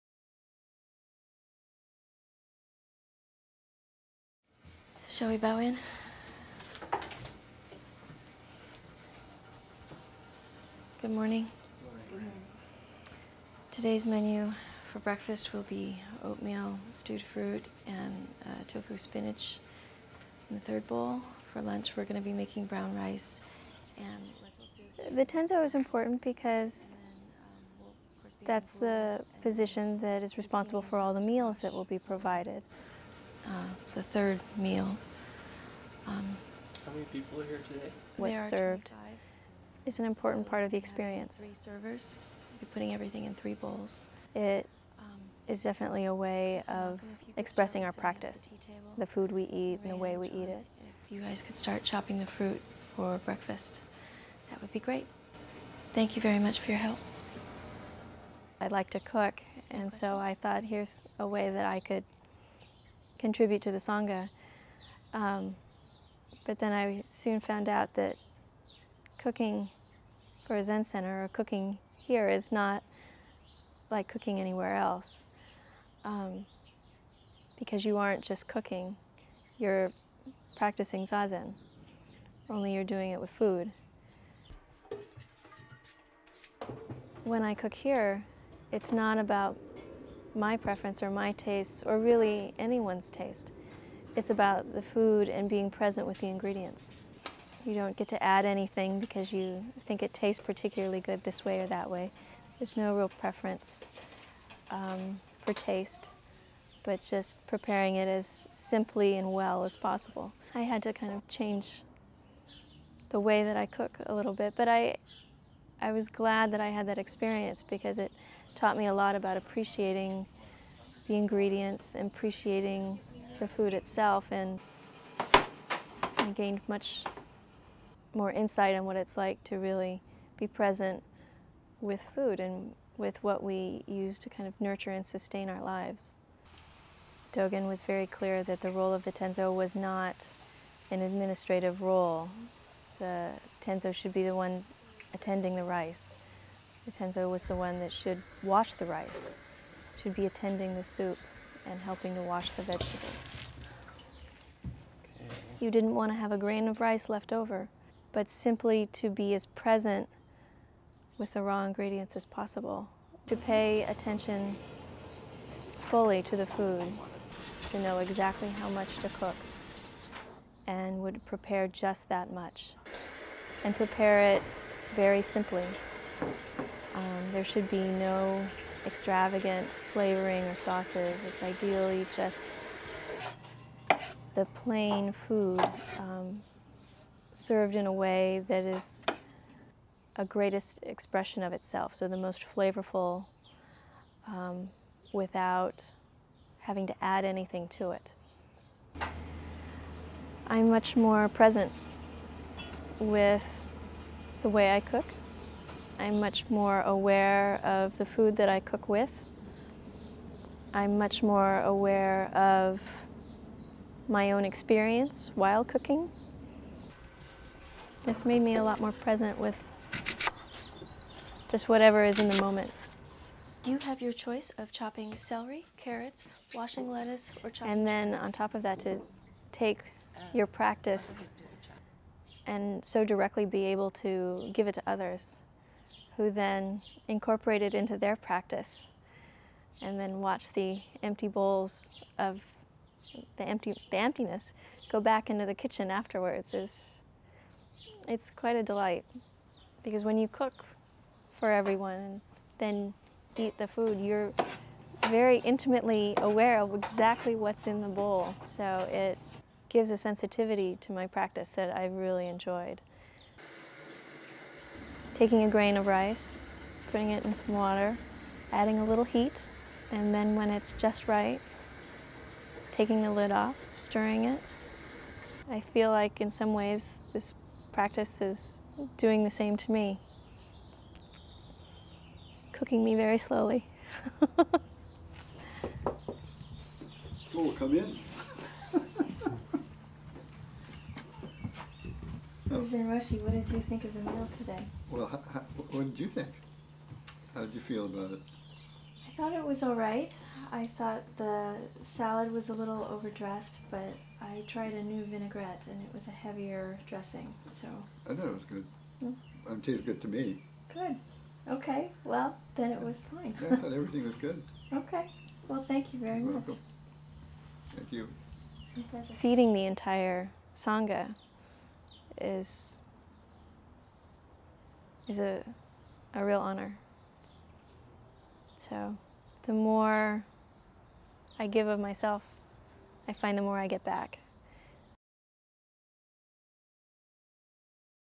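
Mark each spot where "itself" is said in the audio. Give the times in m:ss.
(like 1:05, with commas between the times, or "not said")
2:03, 3:11.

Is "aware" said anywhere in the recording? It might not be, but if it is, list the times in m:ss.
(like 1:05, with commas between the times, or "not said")
3:26, 3:31, 4:16.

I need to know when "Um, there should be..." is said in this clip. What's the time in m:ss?
2:56.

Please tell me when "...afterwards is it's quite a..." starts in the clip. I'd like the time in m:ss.
4:05.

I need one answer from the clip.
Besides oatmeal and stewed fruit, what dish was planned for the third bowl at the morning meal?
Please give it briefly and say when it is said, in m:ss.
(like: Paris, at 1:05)
tofu spinach, at 0:18.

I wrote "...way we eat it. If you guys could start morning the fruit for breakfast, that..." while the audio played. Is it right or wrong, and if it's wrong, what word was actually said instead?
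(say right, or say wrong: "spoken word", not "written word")
wrong: "chopping", not "morning".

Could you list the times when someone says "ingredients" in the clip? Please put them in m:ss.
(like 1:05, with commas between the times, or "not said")
1:36, 2:01, 2:41.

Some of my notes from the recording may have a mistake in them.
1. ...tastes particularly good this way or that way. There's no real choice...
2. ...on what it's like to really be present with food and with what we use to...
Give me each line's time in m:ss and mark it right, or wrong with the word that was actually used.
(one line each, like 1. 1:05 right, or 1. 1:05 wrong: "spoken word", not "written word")
1. 1:40 wrong: "preference", not "choice"
2. 2:08 right.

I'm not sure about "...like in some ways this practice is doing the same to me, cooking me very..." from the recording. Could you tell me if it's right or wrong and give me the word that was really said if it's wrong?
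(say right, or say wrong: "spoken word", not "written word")
right.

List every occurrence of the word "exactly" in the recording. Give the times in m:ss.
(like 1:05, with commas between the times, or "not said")
2:47, 4:16.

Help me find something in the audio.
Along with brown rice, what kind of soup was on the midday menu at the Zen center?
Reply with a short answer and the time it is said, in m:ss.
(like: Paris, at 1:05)
lentil soup, at 0:24.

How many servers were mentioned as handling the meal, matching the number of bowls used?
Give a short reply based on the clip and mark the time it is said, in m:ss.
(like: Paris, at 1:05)
3, at 0:41.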